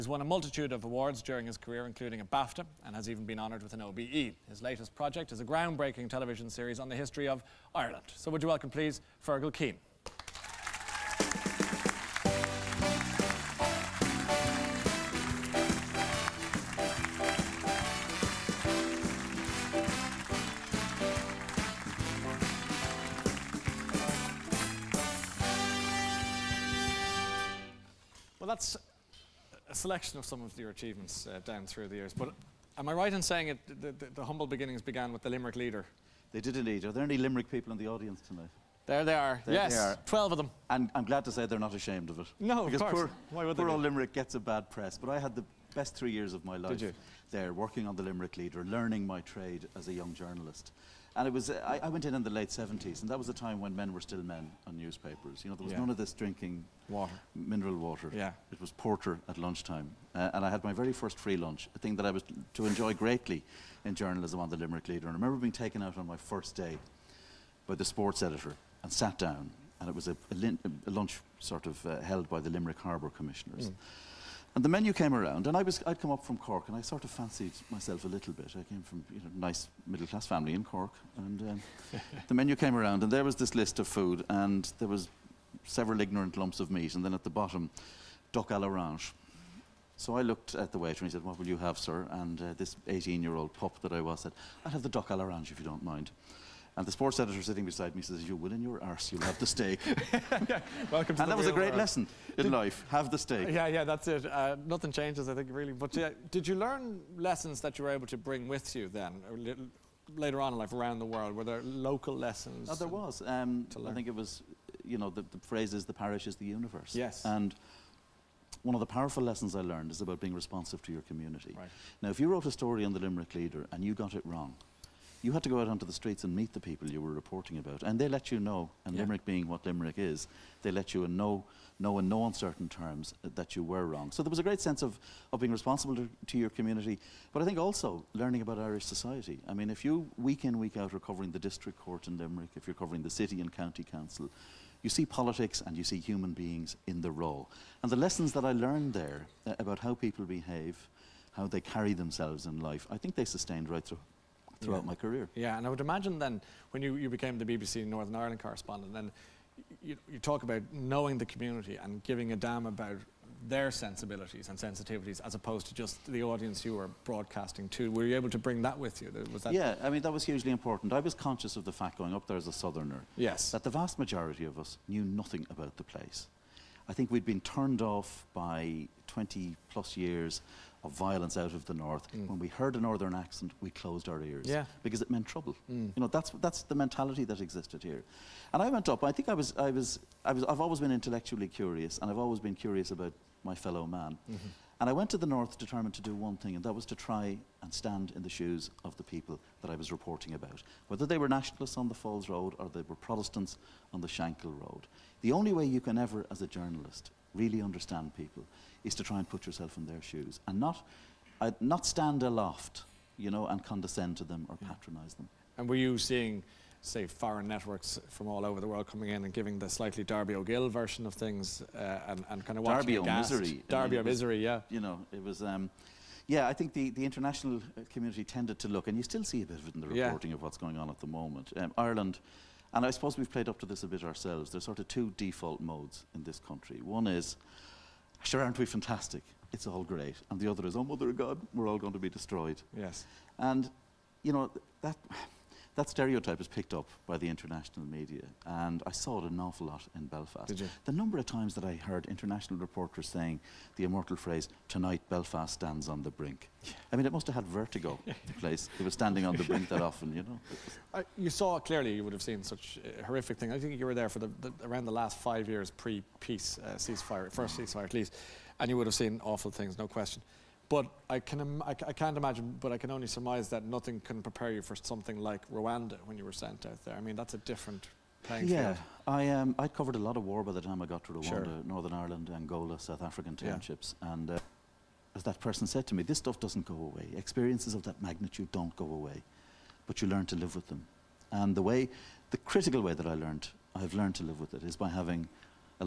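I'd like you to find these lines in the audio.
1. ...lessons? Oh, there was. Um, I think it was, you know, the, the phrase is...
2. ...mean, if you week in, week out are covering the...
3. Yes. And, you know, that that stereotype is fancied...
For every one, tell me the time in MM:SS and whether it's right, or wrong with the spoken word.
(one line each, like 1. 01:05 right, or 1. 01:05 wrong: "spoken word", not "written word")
1. 01:52 right
2. 02:19 right
3. 04:02 wrong: "picked", not "fancied".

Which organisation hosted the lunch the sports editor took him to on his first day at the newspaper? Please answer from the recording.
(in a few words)
Limerick Harbour Commissioners.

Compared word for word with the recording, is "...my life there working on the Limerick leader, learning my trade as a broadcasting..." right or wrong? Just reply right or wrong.
wrong.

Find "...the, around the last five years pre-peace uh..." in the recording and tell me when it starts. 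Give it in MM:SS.
04:24.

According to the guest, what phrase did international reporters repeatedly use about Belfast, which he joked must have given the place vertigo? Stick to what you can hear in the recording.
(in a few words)
Belfast stands on the brink.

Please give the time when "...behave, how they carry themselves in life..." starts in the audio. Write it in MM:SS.
02:30.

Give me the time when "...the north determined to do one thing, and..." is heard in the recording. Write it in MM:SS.
03:15.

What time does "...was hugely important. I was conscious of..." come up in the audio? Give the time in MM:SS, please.
02:50.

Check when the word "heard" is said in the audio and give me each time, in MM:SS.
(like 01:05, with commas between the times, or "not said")
03:02, 04:11.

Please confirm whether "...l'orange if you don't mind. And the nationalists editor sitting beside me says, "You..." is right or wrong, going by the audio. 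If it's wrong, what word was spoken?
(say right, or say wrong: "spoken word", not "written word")
wrong: "sports", not "nationalists".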